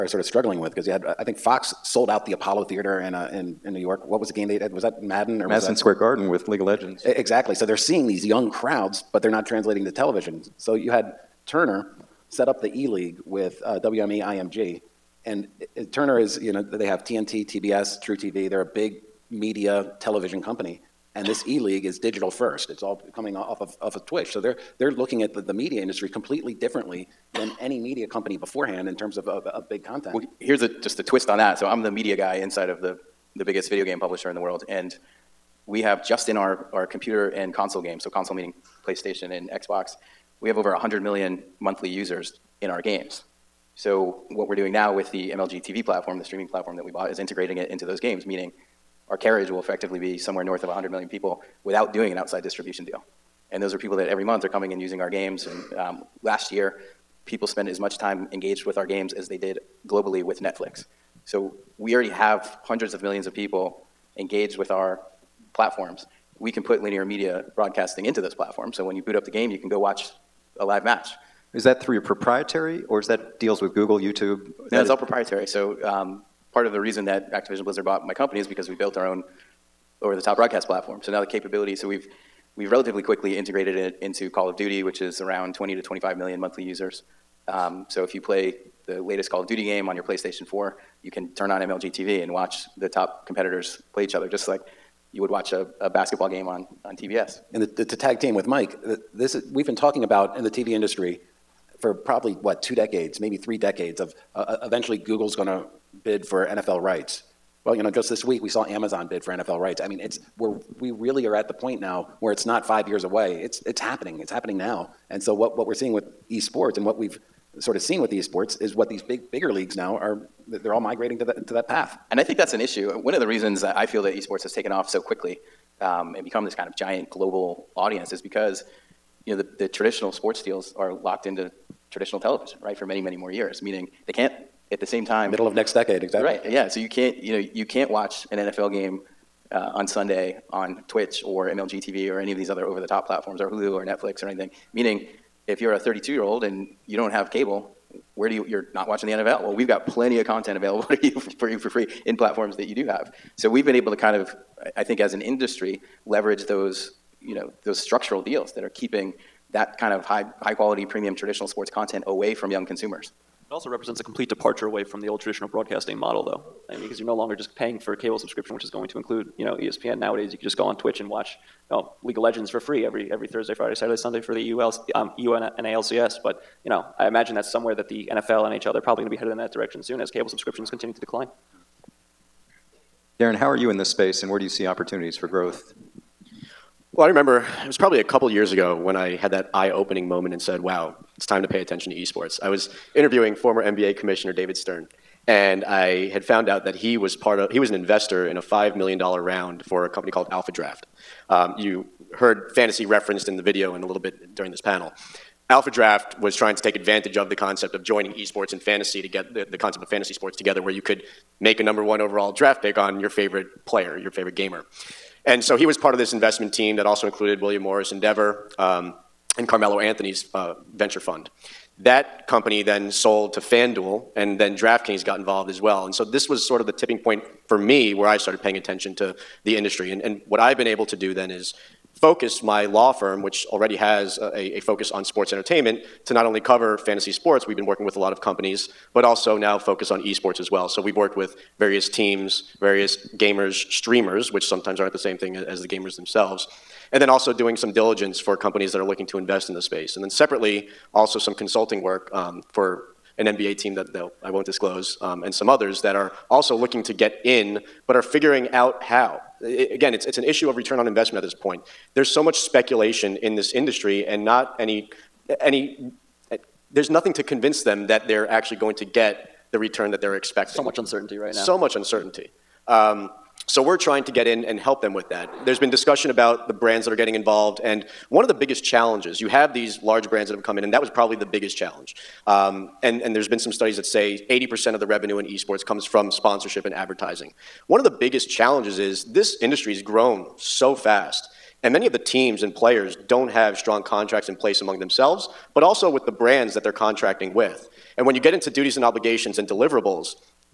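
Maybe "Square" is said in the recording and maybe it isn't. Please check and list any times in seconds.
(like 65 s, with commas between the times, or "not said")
5 s.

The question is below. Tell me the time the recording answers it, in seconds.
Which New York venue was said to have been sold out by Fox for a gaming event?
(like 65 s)
2 s.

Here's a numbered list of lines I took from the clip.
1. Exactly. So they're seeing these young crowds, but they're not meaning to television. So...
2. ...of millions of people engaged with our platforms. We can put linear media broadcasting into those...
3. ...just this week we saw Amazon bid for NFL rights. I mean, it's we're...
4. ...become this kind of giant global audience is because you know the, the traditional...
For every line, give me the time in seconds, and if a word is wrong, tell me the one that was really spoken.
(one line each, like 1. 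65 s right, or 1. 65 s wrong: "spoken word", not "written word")
1. 7 s wrong: "translating", not "meaning"
2. 62 s right
3. 107 s right
4. 126 s right.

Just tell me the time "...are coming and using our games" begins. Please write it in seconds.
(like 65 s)
54 s.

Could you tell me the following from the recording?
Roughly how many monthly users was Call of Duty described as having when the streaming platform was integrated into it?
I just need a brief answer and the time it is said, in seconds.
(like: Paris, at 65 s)
20 to 25 million, at 85 s.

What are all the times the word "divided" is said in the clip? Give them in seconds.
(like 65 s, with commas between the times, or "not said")
not said.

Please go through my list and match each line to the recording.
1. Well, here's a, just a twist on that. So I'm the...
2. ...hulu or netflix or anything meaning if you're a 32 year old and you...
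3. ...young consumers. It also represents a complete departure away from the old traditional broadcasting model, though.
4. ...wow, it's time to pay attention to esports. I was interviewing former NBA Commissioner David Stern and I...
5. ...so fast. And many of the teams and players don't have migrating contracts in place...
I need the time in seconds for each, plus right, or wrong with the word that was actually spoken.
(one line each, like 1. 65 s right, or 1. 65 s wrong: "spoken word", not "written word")
1. 30 s right
2. 143 s right
3. 162 s right
4. 190 s right
5. 290 s wrong: "strong", not "migrating".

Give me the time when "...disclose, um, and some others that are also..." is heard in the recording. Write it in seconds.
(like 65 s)
254 s.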